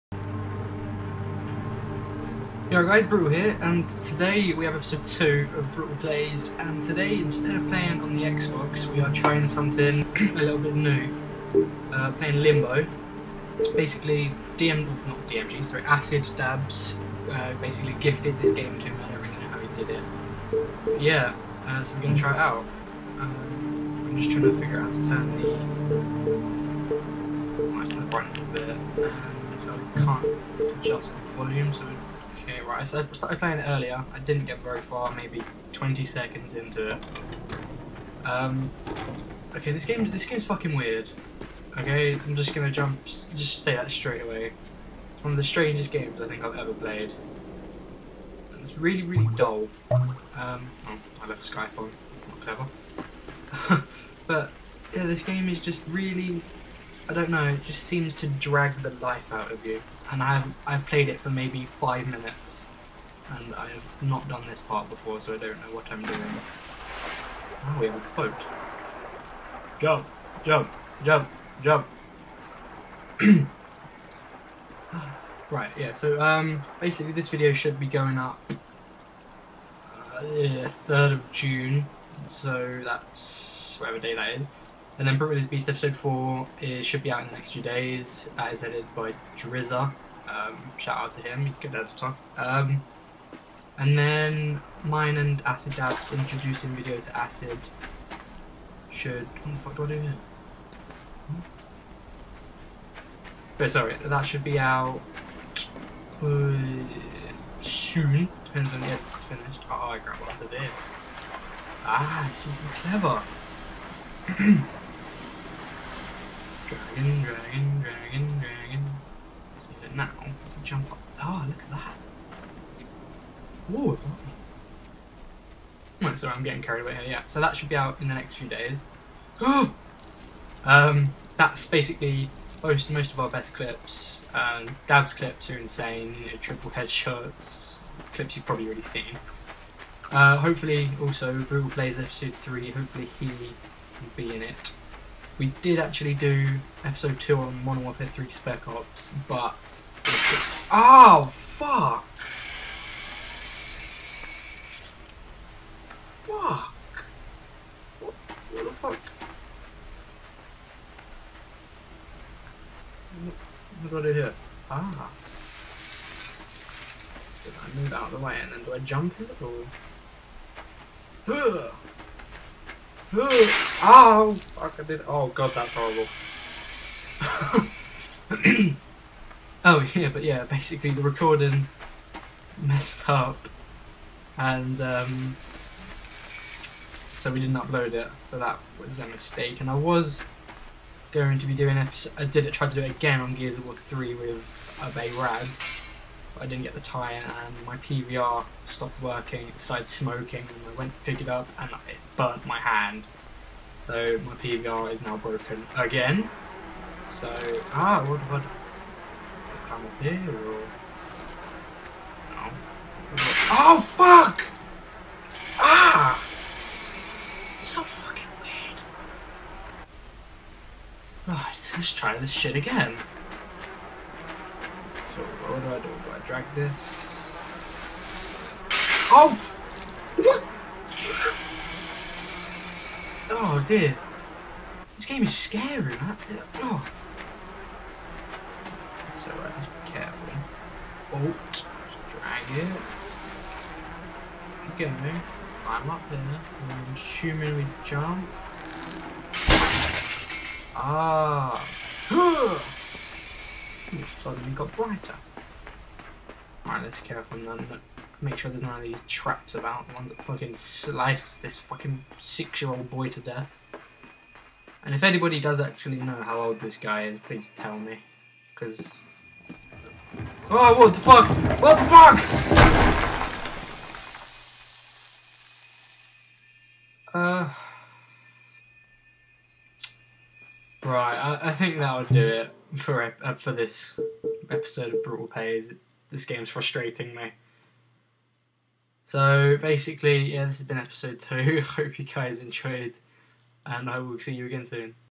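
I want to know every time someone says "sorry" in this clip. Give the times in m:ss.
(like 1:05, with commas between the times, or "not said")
0:15, 1:43, 2:06.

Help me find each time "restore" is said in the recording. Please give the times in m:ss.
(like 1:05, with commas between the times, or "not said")
not said.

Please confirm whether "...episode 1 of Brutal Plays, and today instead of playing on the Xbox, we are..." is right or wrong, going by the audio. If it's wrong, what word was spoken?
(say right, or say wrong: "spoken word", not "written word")
wrong: "2", not "1".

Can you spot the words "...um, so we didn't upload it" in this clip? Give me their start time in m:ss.
3:04.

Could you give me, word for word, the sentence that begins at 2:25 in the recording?
We did actually do episode 2 on Modern Warfare 3 Spec Ops, but...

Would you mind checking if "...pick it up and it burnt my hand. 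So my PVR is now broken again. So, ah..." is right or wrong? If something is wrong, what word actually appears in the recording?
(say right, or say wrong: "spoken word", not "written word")
right.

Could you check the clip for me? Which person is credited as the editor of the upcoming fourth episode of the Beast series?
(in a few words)
Drizza.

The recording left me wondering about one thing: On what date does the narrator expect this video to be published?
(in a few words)
3rd of June.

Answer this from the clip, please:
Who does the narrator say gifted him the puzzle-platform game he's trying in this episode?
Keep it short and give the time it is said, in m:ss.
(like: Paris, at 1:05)
Acid Dabs, at 0:15.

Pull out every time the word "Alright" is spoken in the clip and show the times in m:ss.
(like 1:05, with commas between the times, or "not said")
4:16.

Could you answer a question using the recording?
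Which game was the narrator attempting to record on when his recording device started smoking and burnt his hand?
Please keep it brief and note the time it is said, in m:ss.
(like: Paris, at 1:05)
Gears of War 3, at 3:13.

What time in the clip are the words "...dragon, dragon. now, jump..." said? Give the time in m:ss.
1:57.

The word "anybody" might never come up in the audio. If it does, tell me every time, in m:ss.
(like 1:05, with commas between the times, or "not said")
4:25.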